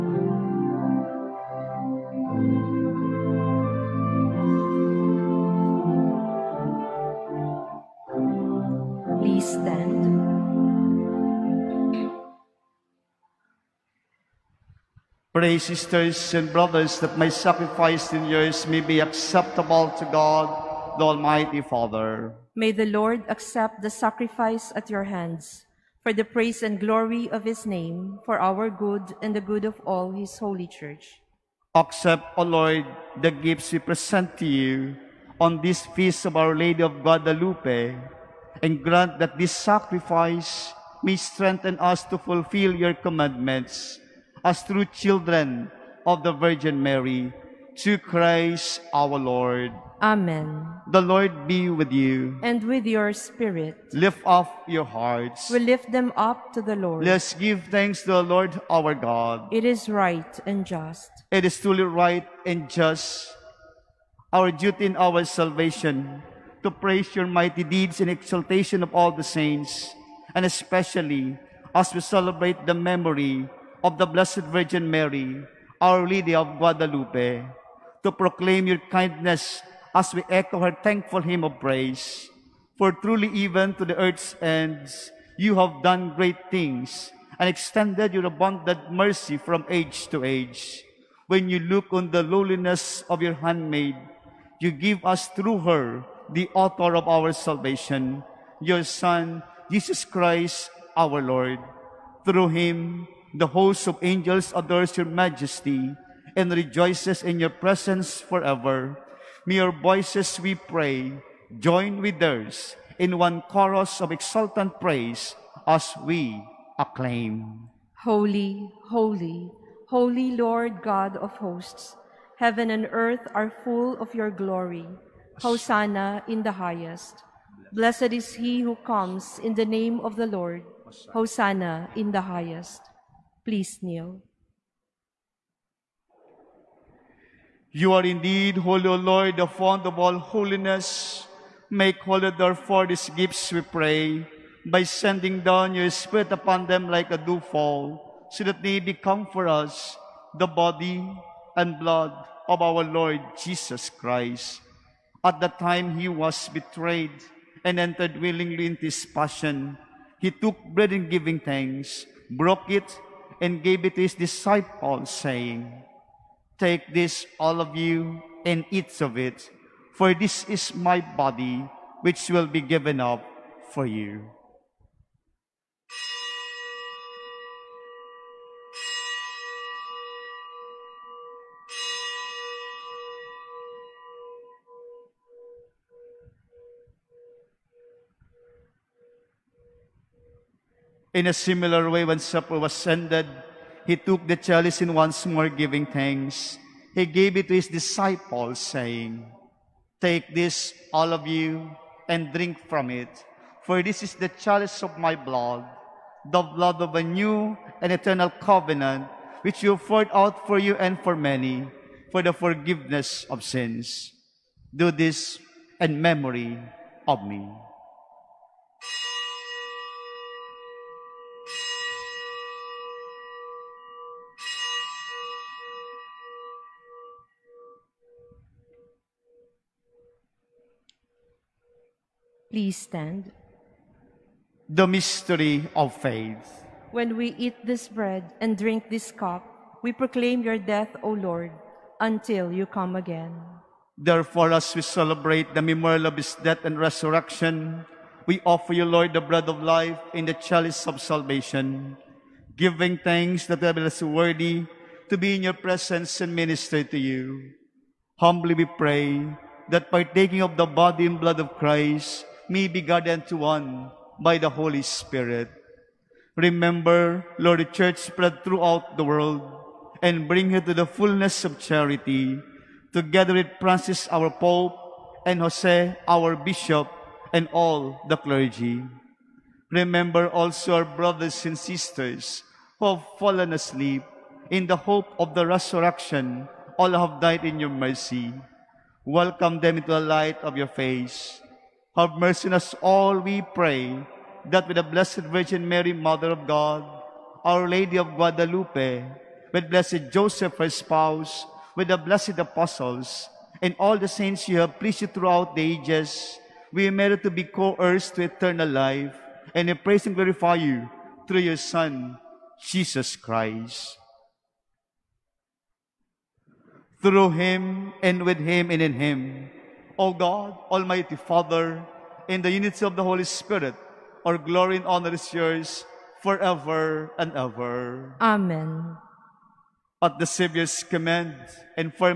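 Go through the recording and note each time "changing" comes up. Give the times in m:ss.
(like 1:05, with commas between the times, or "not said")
not said.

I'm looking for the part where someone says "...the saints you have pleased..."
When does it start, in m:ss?
5:03.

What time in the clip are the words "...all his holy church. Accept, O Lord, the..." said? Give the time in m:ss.
0:29.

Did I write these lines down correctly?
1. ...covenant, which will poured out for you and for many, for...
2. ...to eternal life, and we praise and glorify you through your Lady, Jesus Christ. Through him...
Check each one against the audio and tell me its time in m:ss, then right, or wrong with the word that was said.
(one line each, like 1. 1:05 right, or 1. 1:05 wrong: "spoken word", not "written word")
1. 3:28 right
2. 5:08 wrong: "Son", not "Lady".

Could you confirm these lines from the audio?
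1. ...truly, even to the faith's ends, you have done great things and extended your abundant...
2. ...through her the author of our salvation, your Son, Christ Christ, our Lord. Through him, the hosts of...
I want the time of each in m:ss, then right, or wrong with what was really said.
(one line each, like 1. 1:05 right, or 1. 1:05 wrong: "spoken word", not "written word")
1. 1:22 wrong: "earth", not "faith"
2. 1:35 wrong: "Jesus", not "Christ".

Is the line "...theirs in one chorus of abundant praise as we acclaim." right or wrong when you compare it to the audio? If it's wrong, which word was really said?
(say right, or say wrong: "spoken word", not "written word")
wrong: "exultant", not "abundant".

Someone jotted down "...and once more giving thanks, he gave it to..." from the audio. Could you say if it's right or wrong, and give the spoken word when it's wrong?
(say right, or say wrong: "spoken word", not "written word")
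right.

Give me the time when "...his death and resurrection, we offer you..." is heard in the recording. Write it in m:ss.
4:06.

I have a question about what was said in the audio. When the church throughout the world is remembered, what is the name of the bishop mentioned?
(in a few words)
Jose.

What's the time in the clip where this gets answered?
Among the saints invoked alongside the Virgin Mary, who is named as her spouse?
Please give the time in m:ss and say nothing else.
4:59.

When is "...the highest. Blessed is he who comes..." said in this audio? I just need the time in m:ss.
2:06.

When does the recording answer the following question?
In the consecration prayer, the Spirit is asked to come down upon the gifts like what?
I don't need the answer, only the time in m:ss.
2:26.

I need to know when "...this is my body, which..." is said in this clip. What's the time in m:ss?
2:50.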